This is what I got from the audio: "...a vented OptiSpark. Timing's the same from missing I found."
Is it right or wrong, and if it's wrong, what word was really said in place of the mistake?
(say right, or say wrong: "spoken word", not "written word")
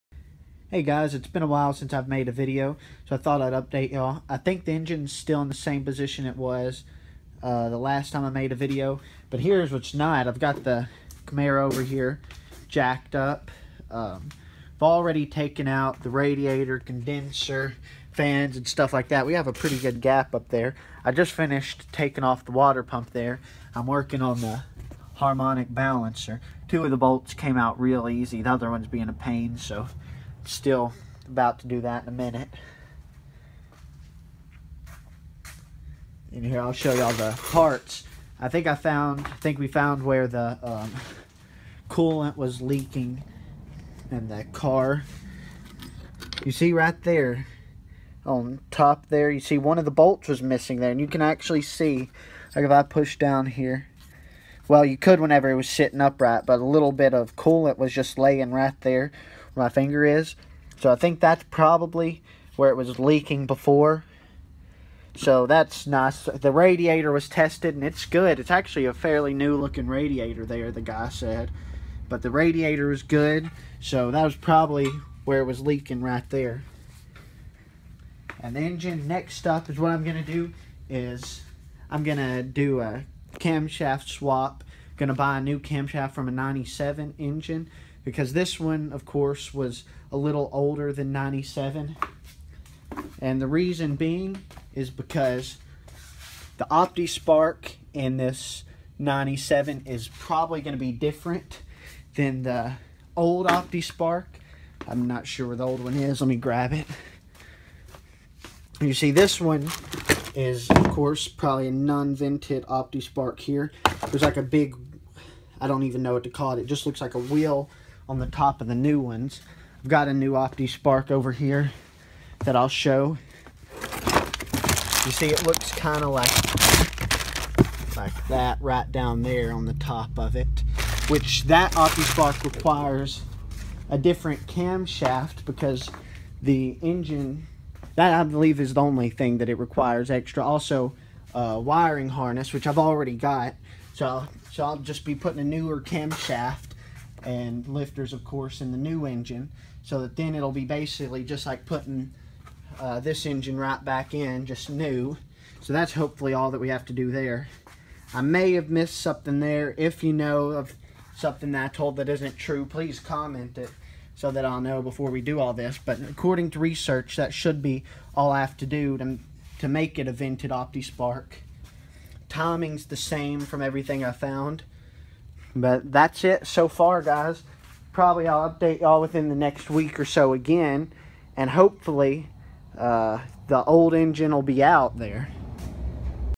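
wrong: "everything", not "missing".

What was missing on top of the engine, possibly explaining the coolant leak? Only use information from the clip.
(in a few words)
one of the bolts.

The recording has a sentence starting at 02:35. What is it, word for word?
So that's hopefully all that we have to do there.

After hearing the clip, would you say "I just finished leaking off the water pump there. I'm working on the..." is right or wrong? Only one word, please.
wrong.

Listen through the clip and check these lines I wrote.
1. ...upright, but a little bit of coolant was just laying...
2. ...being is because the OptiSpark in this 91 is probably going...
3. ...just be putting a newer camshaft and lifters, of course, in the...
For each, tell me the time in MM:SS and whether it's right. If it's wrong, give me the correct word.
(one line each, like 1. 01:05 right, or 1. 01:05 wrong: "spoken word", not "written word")
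1. 00:55 right
2. 01:33 wrong: "97", not "91"
3. 02:24 right.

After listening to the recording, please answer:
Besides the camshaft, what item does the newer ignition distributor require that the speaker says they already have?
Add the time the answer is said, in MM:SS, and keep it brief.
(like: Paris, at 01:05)
wiring harness, at 02:21.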